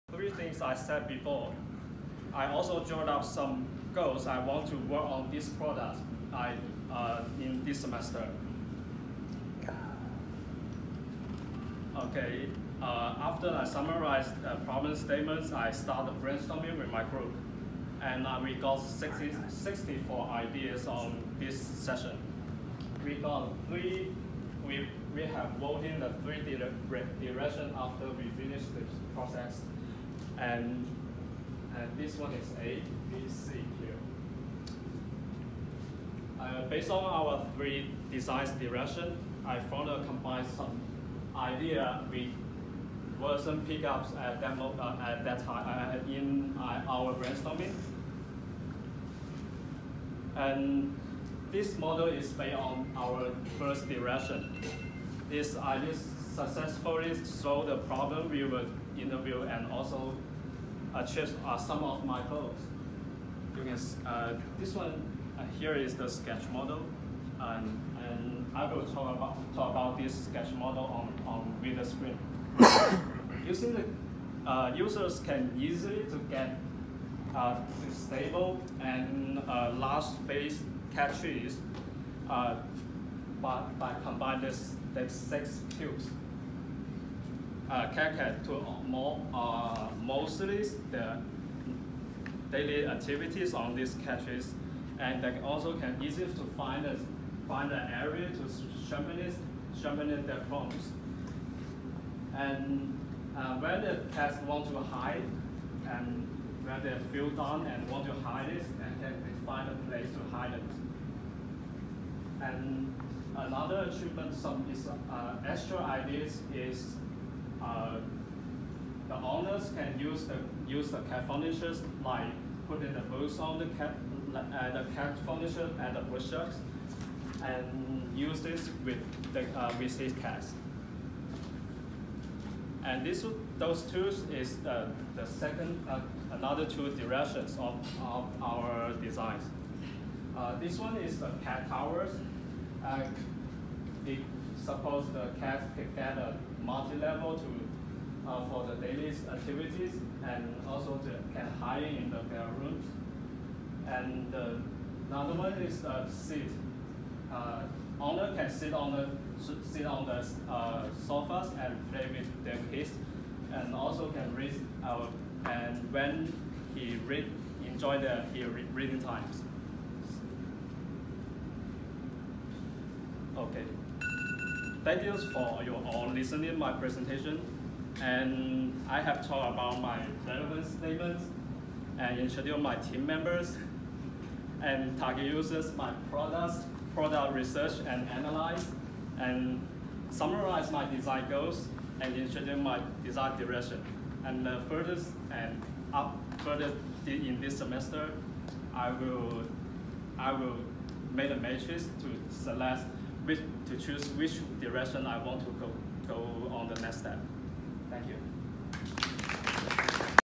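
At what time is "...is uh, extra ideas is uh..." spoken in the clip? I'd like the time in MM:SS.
01:54.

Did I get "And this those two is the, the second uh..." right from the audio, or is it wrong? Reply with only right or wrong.
right.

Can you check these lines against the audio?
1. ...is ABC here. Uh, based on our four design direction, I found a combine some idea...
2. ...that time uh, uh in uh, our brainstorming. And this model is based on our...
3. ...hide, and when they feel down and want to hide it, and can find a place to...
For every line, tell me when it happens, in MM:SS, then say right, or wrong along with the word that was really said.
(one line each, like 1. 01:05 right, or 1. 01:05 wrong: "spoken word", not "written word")
1. 00:32 wrong: "three", not "four"
2. 00:45 right
3. 01:44 right.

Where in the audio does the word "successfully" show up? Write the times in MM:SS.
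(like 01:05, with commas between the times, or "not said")
00:56.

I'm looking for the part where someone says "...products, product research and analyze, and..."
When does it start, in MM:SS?
03:06.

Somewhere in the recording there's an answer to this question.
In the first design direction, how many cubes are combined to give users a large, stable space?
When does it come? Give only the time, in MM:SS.
01:25.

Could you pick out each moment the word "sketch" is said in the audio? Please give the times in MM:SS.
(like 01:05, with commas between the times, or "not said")
01:06, 01:10.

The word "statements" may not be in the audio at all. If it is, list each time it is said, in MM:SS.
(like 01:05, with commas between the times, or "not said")
00:14, 03:00.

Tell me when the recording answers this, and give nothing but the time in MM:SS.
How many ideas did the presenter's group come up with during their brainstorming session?
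00:19.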